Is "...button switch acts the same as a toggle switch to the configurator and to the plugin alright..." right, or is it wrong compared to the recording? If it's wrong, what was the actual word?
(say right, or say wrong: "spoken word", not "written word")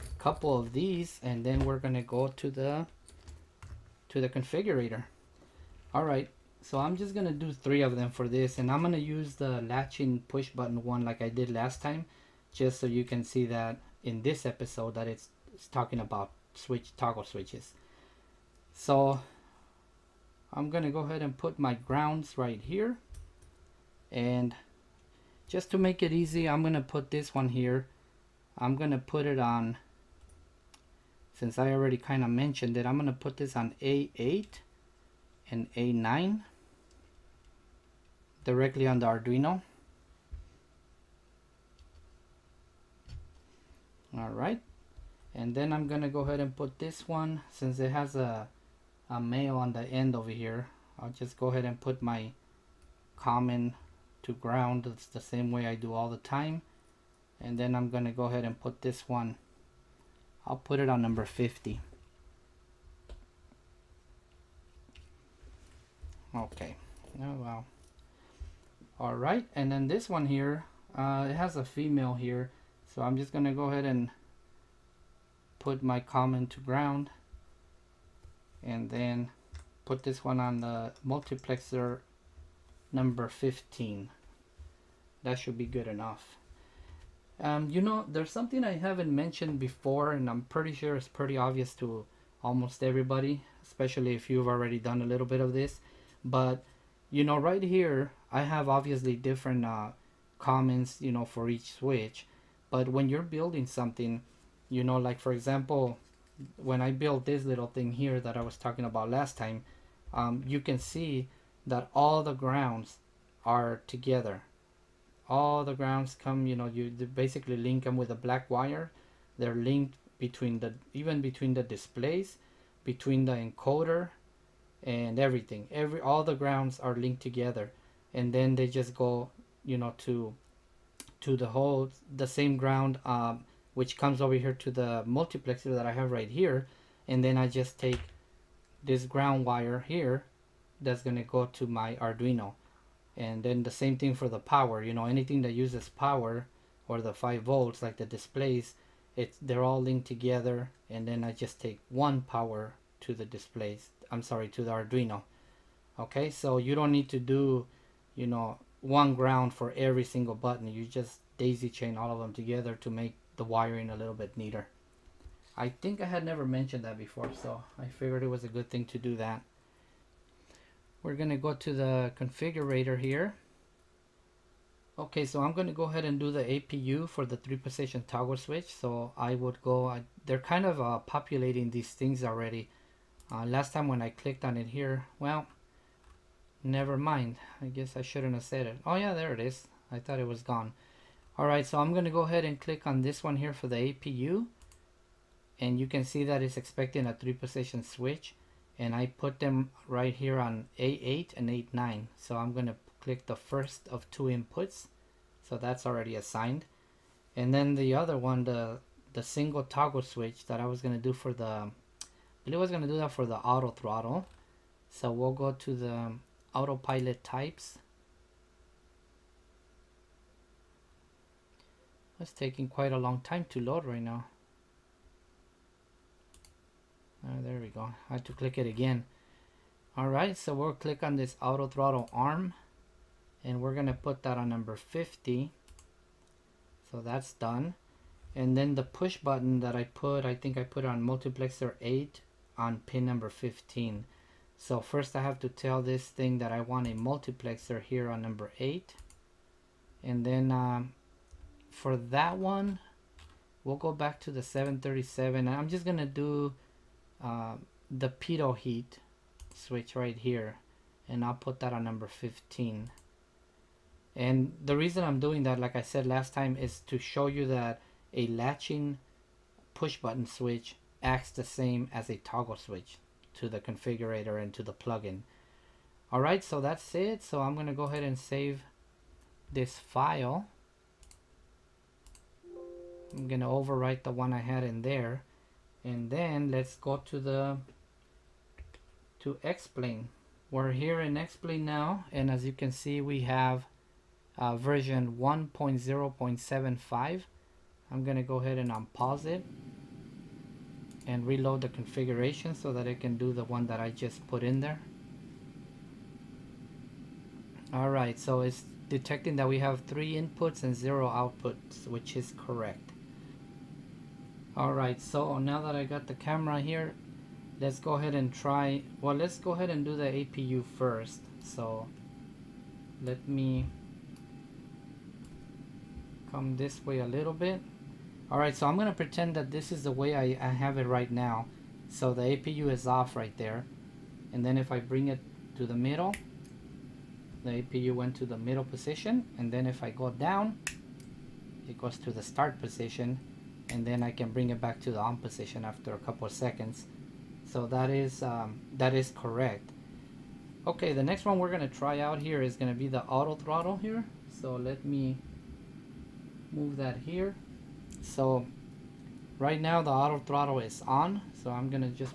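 right.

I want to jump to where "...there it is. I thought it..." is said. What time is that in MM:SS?
03:09.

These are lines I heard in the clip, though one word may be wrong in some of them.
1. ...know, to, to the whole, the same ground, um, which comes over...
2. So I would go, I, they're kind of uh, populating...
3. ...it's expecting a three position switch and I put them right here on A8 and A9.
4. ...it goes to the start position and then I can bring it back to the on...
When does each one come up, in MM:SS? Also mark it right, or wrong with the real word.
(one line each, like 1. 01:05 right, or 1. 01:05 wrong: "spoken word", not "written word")
1. 02:09 right
2. 02:58 right
3. 03:16 right
4. 05:41 right.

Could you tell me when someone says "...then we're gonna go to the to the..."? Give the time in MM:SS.
00:01.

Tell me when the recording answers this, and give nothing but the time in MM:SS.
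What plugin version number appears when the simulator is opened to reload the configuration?
04:55.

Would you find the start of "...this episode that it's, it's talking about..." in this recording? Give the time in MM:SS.
00:14.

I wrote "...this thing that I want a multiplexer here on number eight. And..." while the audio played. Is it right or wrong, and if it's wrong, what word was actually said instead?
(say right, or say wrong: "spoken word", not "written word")
right.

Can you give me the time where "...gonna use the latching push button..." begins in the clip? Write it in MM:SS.
00:08.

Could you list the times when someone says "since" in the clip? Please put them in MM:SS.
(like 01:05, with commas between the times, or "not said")
00:31, 00:47.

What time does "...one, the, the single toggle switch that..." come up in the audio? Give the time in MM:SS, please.
03:28.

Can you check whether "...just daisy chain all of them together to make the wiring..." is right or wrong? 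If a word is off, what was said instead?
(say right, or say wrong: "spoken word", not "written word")
right.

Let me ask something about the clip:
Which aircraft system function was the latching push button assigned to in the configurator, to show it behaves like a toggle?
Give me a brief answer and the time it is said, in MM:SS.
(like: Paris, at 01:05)
Pitot heat, at 04:18.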